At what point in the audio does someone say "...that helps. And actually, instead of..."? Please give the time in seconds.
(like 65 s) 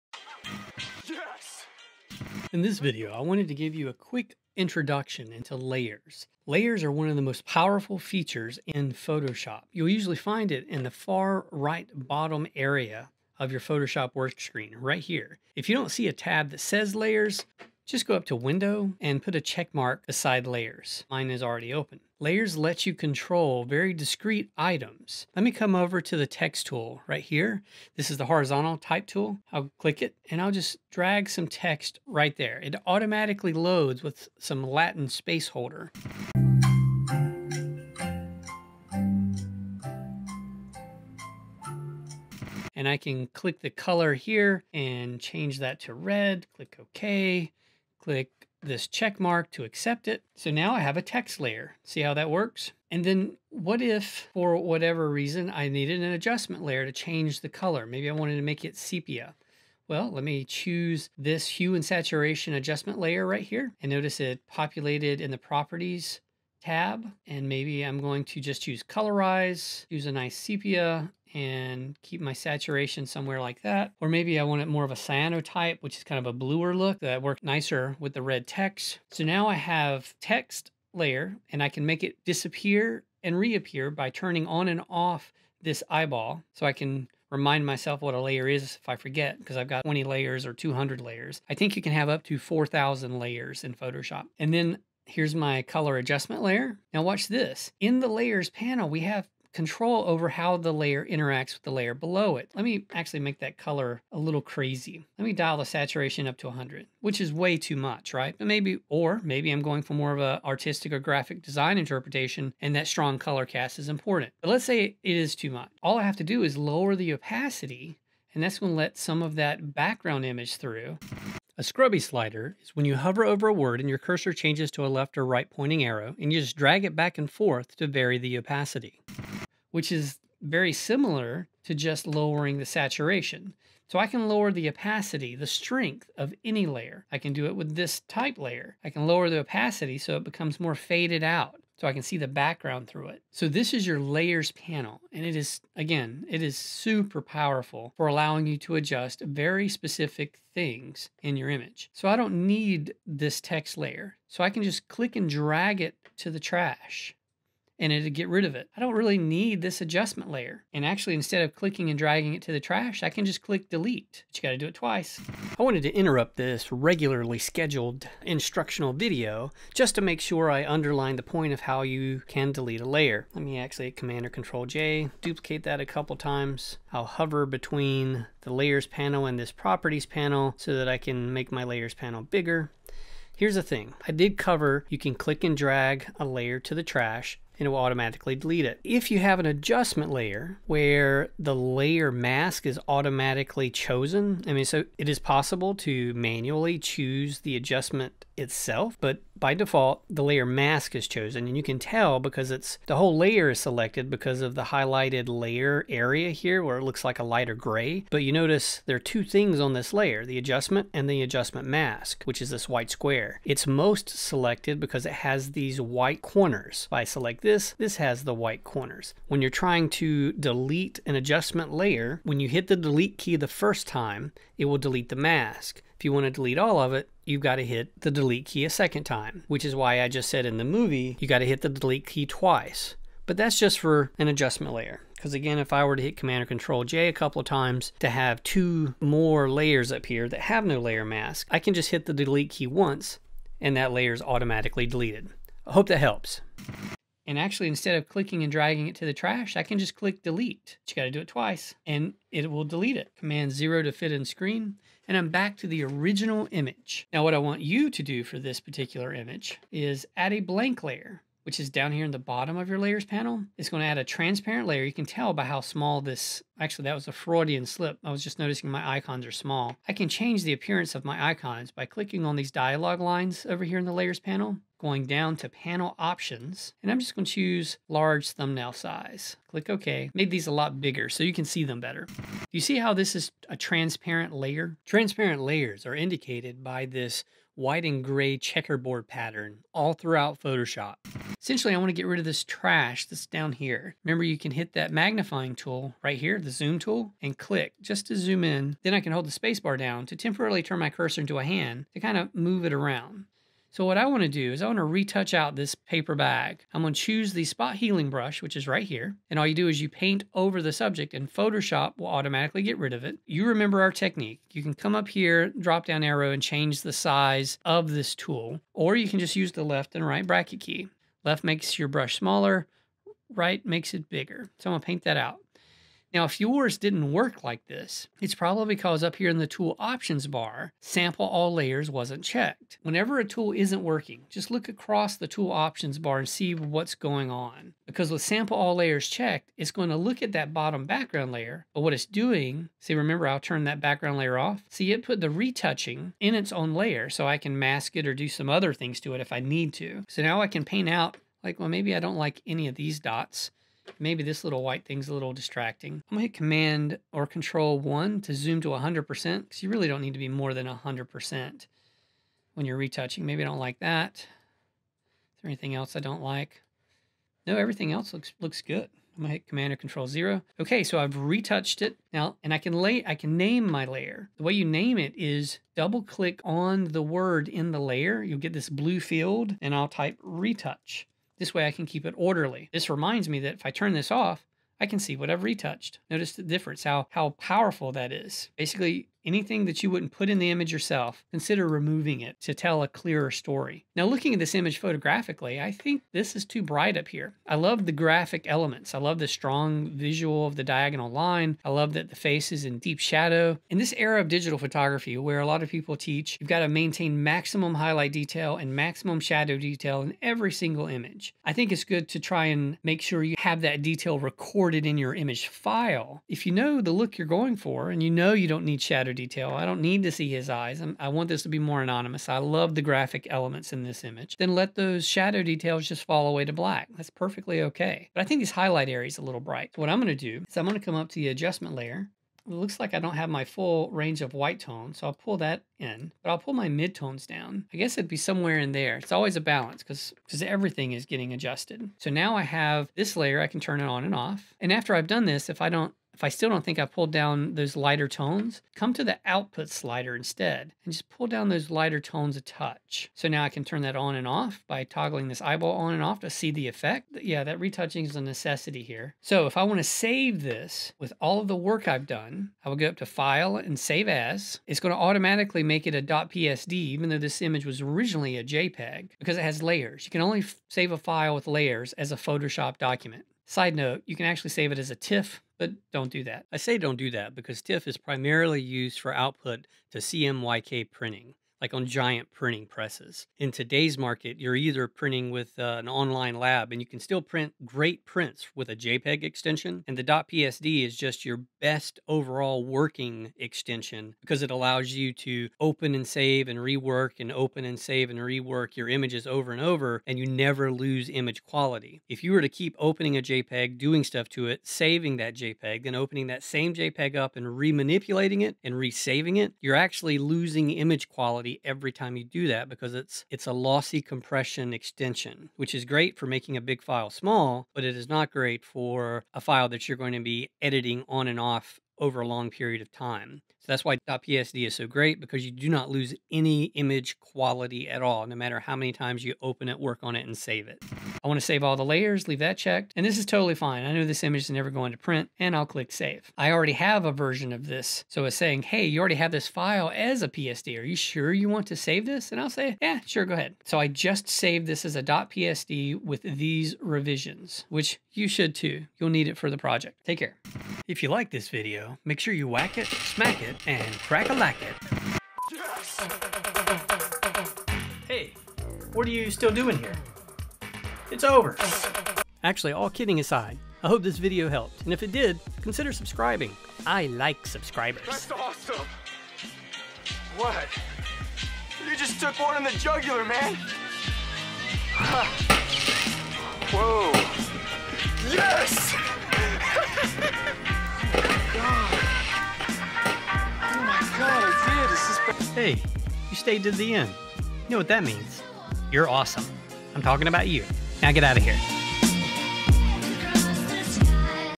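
245 s.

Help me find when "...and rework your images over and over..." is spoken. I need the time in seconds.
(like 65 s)
498 s.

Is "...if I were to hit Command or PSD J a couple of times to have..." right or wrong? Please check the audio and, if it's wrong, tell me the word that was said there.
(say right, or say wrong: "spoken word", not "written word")
wrong: "Control", not "PSD".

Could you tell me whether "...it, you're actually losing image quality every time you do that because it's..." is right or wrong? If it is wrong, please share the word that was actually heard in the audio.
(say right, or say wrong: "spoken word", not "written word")
right.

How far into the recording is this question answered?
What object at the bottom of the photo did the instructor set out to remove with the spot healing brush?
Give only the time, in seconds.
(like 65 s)
305 s.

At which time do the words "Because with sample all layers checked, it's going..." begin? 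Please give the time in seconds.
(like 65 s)
337 s.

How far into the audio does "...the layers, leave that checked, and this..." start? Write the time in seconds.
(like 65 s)
531 s.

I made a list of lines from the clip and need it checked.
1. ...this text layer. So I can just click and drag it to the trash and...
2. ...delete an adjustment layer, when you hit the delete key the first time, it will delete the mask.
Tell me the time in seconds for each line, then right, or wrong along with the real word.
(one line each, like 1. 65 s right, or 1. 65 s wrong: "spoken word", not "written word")
1. 153 s right
2. 220 s right.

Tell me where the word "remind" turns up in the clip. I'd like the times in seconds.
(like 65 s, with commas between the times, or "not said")
87 s, 382 s.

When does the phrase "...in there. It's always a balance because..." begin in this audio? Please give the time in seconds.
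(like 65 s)
438 s.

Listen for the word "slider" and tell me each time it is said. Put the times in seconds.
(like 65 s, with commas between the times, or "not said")
121 s, 449 s.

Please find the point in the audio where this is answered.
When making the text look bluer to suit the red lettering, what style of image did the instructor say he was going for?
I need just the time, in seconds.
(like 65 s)
74 s.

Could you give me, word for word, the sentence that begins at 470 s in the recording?
You can only save a file with layers as a Photoshop document.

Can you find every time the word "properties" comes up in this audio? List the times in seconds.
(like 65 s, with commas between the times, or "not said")
65 s, 179 s.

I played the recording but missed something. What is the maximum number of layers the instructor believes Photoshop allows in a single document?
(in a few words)
4,000.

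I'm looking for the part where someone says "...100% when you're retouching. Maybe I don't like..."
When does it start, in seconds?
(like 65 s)
360 s.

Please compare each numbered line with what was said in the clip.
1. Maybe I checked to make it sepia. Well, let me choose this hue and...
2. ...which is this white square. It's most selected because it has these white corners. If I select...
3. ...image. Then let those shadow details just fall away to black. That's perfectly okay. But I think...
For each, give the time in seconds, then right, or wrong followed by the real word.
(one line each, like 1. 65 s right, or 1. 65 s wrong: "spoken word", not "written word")
1. 57 s wrong: "wanted", not "checked"
2. 212 s right
3. 424 s right.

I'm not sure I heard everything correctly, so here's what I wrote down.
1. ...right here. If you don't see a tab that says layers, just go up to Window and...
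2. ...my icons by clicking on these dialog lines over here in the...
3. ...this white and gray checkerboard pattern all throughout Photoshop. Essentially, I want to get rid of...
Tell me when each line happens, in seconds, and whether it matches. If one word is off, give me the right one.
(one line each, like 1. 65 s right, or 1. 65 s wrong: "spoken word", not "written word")
1. 14 s right
2. 271 s right
3. 286 s right.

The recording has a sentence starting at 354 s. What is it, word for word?
Maybe this little white thing's a little distracting.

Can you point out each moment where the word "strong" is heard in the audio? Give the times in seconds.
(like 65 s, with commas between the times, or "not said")
112 s, 399 s.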